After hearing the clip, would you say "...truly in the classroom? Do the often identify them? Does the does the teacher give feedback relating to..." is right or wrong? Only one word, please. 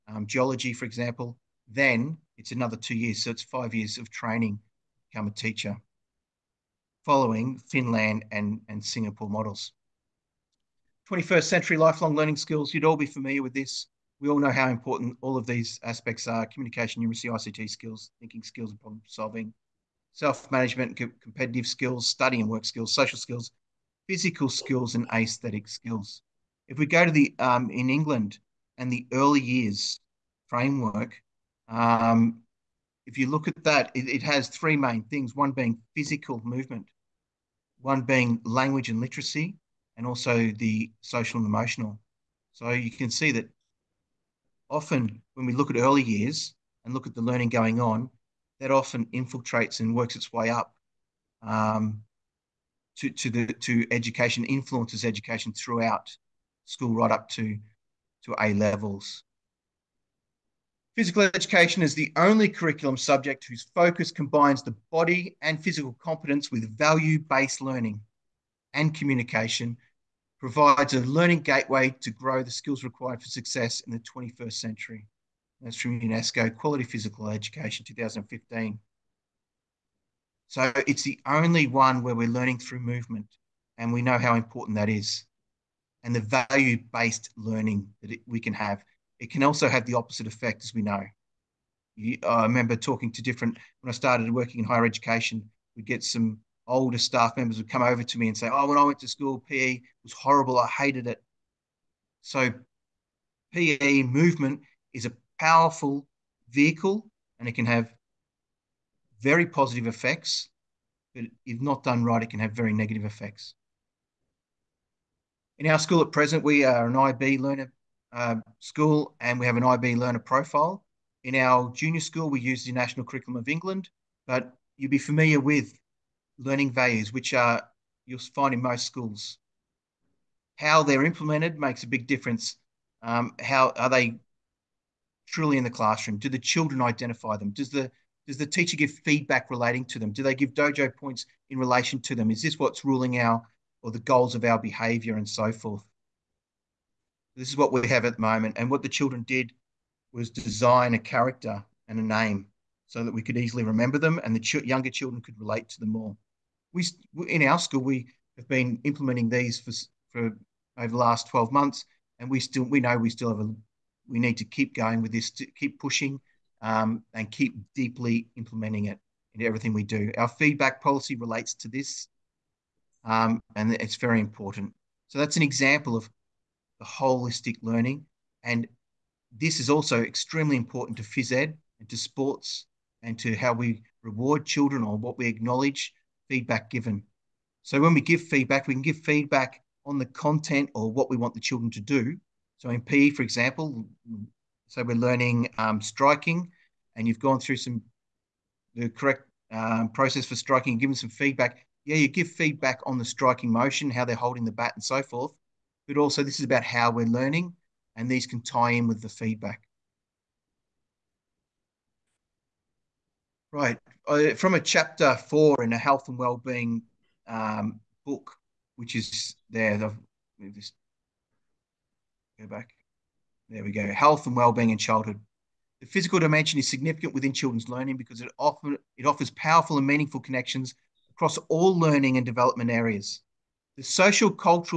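wrong.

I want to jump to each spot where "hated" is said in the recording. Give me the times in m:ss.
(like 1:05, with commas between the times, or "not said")
1:40.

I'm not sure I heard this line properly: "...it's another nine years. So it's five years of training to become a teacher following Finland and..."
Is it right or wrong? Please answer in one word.
wrong.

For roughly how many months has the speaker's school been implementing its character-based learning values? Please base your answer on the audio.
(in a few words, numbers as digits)
12.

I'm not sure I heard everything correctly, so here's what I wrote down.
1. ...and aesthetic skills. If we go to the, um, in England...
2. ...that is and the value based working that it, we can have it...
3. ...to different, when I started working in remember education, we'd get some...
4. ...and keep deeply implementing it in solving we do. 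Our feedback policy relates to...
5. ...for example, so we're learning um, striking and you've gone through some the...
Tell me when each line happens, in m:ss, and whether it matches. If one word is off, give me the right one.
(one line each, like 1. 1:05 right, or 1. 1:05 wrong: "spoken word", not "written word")
1. 0:24 right
2. 1:24 wrong: "learning", not "working"
3. 1:33 wrong: "higher", not "remember"
4. 2:47 wrong: "everything", not "solving"
5. 3:13 right.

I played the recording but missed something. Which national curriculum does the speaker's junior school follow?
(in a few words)
National Curriculum of England.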